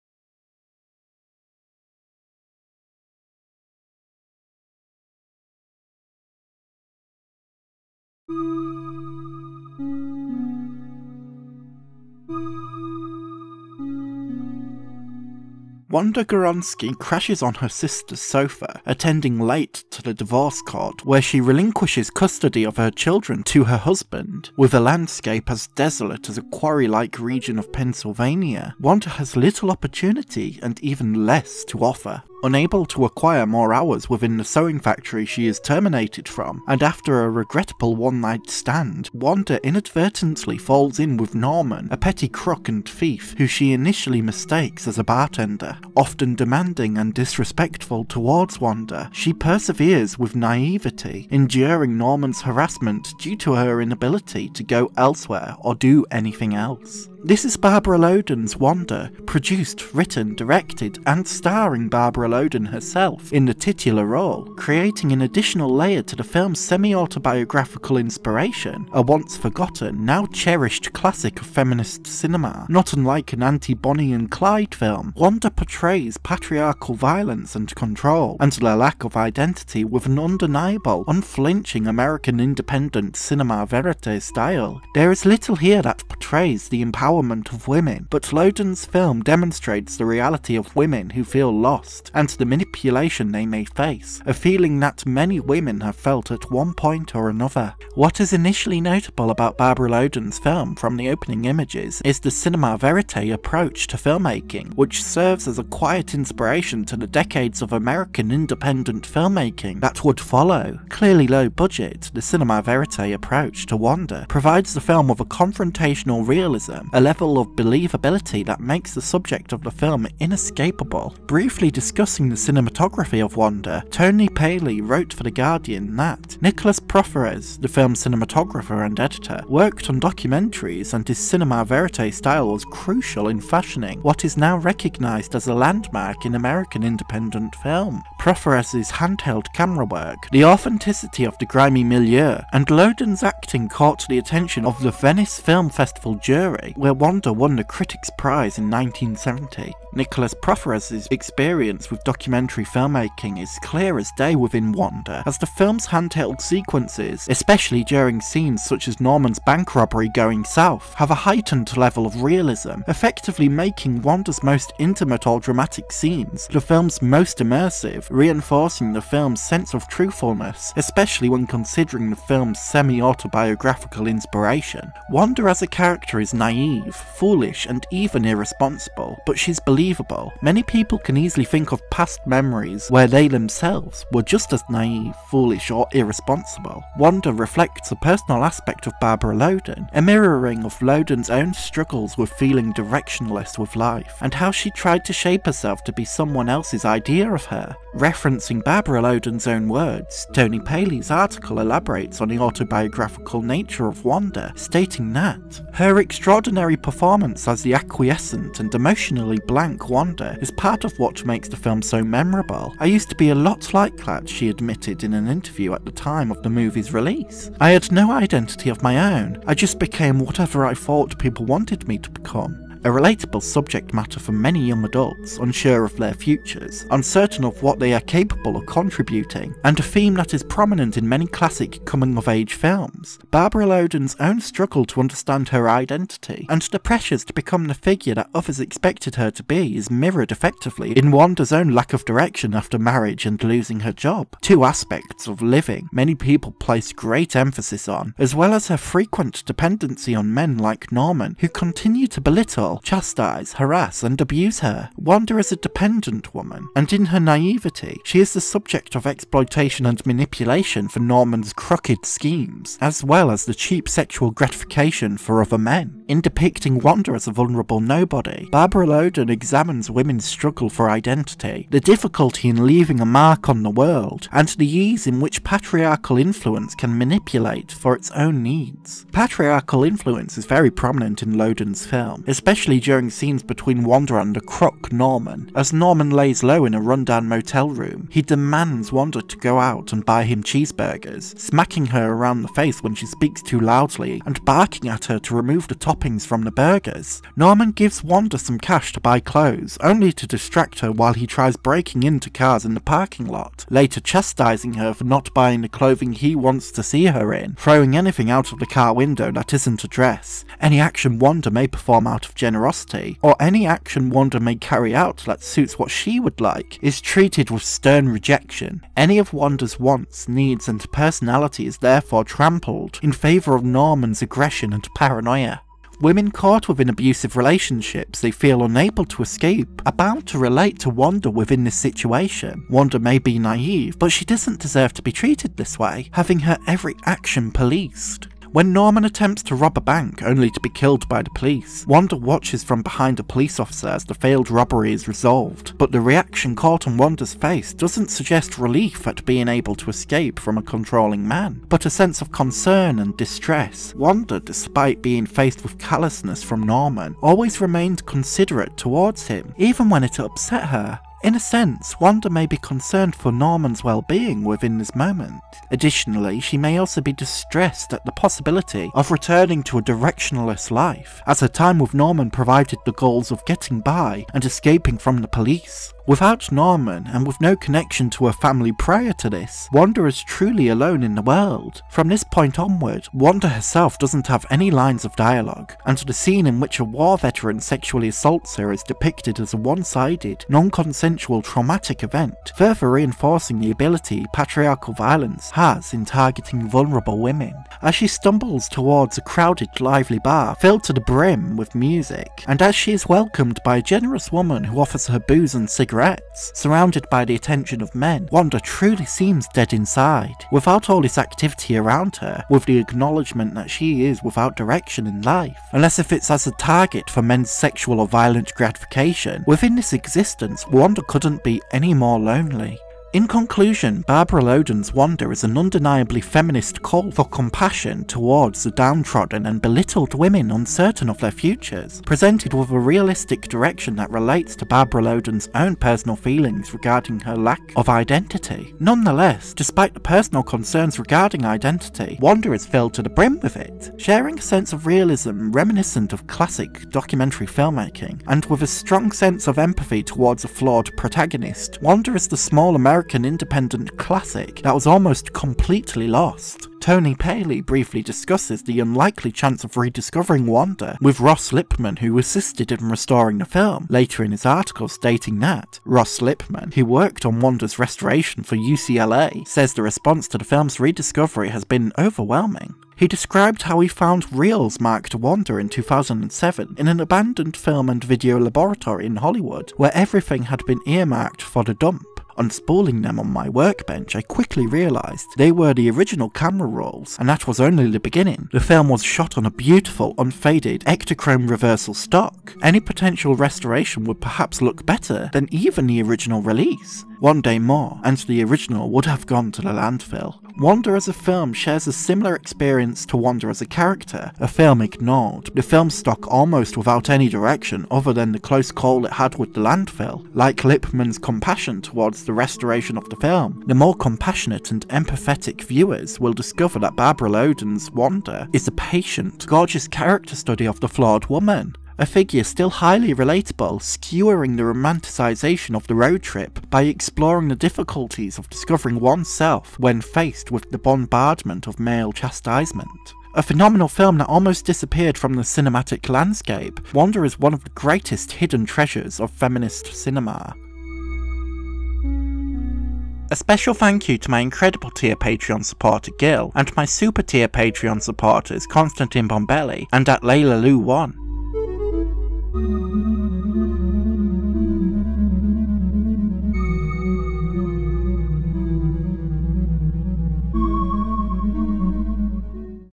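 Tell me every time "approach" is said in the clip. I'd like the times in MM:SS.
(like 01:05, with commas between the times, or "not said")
01:43, 01:53.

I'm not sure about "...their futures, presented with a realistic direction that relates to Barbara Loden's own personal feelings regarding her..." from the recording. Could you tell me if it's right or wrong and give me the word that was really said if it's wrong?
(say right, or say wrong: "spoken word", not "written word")
right.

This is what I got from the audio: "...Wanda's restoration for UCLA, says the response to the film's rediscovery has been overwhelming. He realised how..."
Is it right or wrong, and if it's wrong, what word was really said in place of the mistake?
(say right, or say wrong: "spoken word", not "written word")
wrong: "described", not "realised".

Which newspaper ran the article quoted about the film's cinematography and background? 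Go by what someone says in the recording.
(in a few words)
The Guardian.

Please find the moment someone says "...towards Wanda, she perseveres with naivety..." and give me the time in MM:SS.
00:48.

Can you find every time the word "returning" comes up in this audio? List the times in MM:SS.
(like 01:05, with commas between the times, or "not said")
06:09.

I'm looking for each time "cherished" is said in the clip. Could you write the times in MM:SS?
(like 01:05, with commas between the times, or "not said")
01:10.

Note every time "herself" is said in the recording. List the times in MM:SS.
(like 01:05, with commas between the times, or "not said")
01:02, 03:15, 06:23.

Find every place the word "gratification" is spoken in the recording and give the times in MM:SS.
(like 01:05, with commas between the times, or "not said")
04:24, 06:58.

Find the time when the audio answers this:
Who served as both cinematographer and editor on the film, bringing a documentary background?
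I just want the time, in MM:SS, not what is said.
02:06.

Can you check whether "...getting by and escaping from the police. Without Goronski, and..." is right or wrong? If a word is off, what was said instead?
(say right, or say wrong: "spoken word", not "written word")
wrong: "Norman", not "Goronski".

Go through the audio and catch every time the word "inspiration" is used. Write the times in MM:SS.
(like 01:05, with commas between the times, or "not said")
01:07, 01:46, 02:54.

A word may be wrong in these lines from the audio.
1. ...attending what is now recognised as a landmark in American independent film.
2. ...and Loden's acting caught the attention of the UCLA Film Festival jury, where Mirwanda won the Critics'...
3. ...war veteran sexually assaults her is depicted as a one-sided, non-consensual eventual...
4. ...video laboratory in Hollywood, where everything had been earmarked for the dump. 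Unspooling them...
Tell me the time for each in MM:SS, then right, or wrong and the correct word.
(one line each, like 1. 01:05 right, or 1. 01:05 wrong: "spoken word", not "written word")
1. 02:13 wrong: "fashioning", not "attending"
2. 02:22 wrong: "Venice", not "UCLA"
3. 06:26 right
4. 07:58 right.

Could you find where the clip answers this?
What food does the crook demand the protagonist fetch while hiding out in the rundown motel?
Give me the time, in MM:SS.
04:50.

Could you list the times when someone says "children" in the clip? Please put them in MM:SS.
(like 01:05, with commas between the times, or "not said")
00:22.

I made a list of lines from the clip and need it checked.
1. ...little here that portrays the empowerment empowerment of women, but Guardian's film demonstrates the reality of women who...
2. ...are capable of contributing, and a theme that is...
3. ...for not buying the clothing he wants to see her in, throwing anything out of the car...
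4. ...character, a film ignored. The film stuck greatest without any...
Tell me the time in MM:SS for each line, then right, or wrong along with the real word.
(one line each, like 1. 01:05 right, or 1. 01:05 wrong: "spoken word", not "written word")
1. 01:25 wrong: "Loden", not "Guardian"
2. 03:47 right
3. 05:04 right
4. 08:23 wrong: "almost", not "greatest".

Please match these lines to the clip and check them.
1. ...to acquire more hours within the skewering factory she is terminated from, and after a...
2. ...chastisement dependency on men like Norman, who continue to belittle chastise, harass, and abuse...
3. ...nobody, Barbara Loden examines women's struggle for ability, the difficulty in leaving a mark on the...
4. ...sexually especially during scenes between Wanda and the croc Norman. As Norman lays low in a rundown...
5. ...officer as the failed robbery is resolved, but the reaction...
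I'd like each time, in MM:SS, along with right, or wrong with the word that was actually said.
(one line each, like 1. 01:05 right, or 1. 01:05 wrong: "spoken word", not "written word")
1. 00:32 wrong: "sewing", not "skewering"
2. 04:08 wrong: "frequent", not "chastisement"
3. 04:27 wrong: "identity", not "ability"
4. 04:42 wrong: "especially", not "sexually"
5. 05:43 right.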